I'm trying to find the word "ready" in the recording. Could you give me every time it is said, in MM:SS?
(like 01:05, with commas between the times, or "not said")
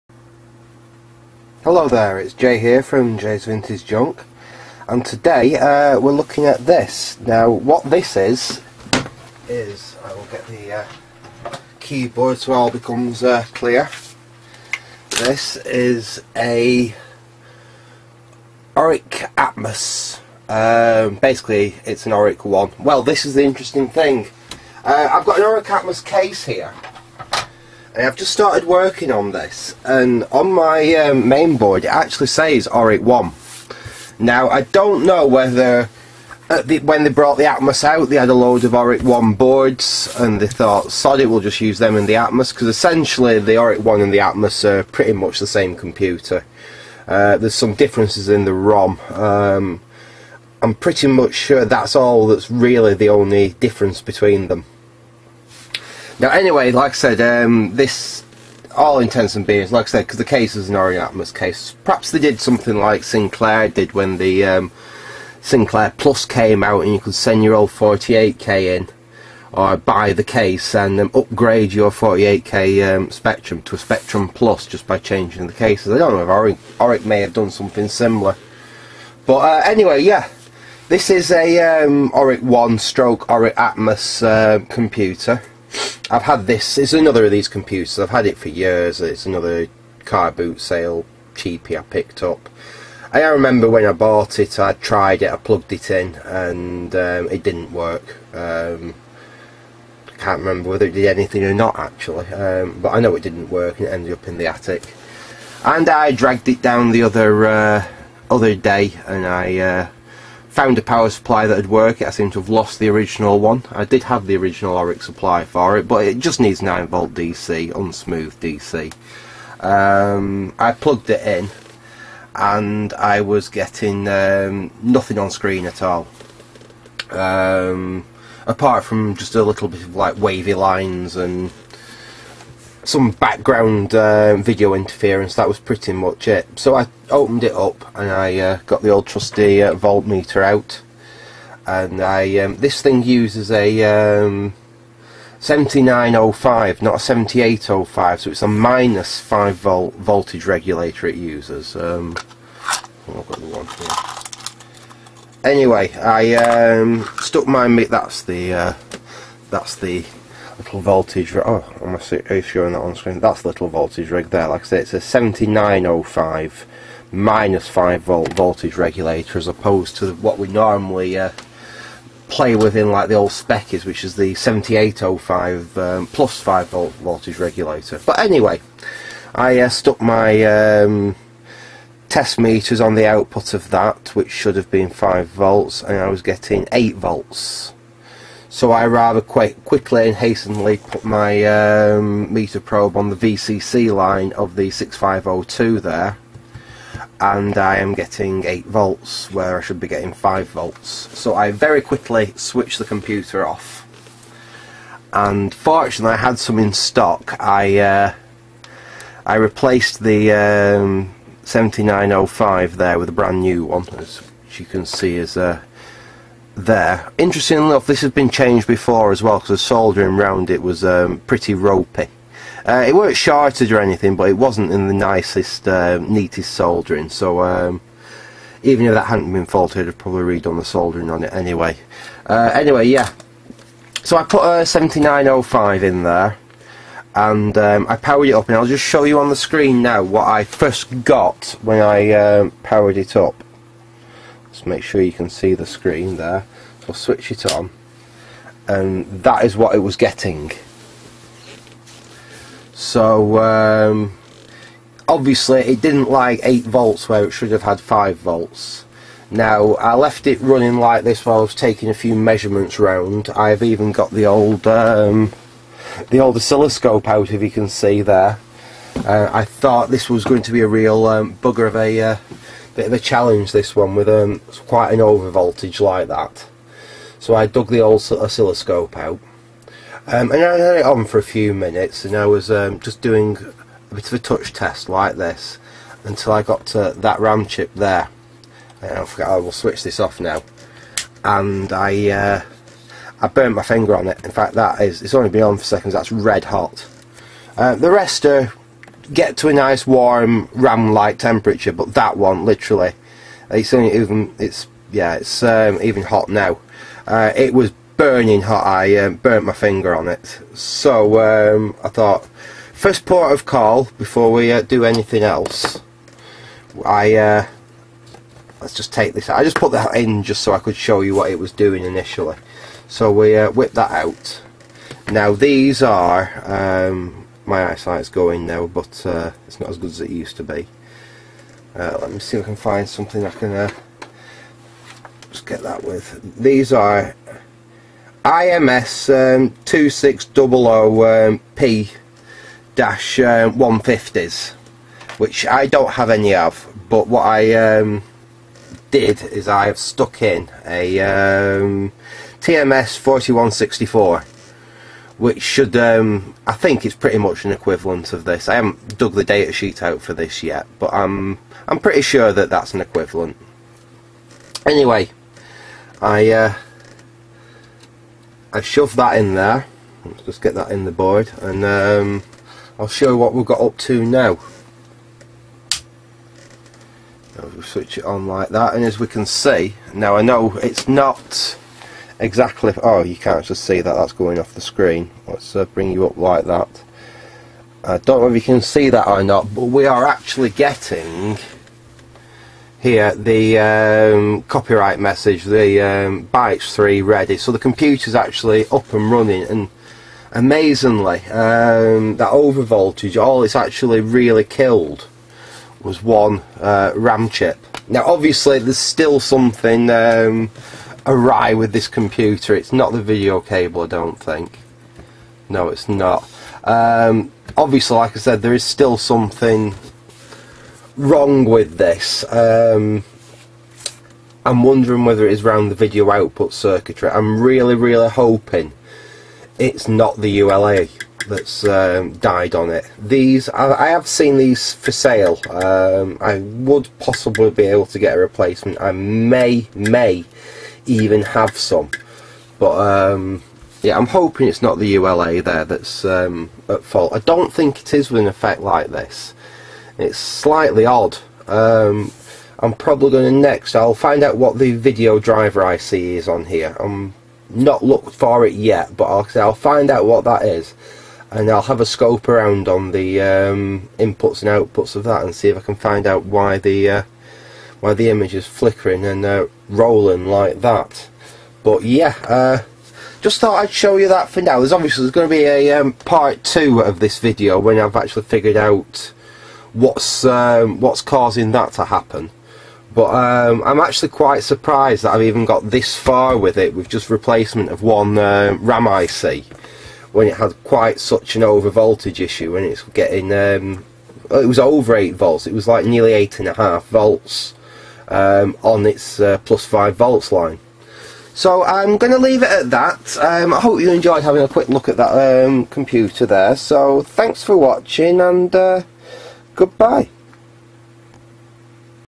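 06:37.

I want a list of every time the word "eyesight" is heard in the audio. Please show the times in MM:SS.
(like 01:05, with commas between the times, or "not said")
05:27.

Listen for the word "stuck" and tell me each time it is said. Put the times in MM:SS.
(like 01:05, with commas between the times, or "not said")
02:37, 02:59, 05:49.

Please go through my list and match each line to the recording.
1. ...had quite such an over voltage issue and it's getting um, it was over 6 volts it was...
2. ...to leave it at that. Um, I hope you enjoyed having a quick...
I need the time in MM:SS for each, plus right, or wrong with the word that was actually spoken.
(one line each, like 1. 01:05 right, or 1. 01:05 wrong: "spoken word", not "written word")
1. 08:10 wrong: "8", not "6"
2. 08:22 right.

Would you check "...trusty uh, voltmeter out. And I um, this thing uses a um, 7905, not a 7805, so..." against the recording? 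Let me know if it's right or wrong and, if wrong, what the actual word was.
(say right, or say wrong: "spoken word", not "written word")
right.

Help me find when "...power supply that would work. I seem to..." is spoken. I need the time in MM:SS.
01:50.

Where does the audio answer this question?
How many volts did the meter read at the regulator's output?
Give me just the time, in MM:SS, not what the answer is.
03:05.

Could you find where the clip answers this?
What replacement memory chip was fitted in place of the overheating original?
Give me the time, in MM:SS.
05:52.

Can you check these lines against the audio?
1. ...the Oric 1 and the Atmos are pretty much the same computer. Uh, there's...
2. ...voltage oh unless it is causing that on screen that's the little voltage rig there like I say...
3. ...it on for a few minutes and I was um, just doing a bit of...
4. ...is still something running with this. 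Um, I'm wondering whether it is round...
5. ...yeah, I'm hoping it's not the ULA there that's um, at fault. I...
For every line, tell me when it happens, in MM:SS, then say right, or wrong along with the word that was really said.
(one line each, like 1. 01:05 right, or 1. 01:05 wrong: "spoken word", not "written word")
1. 00:43 right
2. 02:40 wrong: "showing", not "causing"
3. 04:40 right
4. 06:58 wrong: "wrong", not "running"
5. 07:23 right.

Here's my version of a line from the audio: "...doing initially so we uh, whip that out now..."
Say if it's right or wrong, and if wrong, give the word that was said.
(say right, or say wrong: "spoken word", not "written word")
right.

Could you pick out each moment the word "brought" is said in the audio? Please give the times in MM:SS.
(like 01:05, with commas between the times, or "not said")
00:37.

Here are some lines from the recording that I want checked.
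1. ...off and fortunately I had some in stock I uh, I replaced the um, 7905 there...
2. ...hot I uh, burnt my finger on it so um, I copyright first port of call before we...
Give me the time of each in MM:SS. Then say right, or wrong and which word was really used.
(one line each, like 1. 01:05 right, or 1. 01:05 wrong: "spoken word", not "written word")
1. 03:23 right
2. 05:08 wrong: "thought", not "copyright".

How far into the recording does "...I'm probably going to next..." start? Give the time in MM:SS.
07:32.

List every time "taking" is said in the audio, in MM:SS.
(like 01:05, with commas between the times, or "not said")
04:21.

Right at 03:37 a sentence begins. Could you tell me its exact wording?
Interestingly enough, this has been changed before as well because the soldering round it was um, pretty ropey.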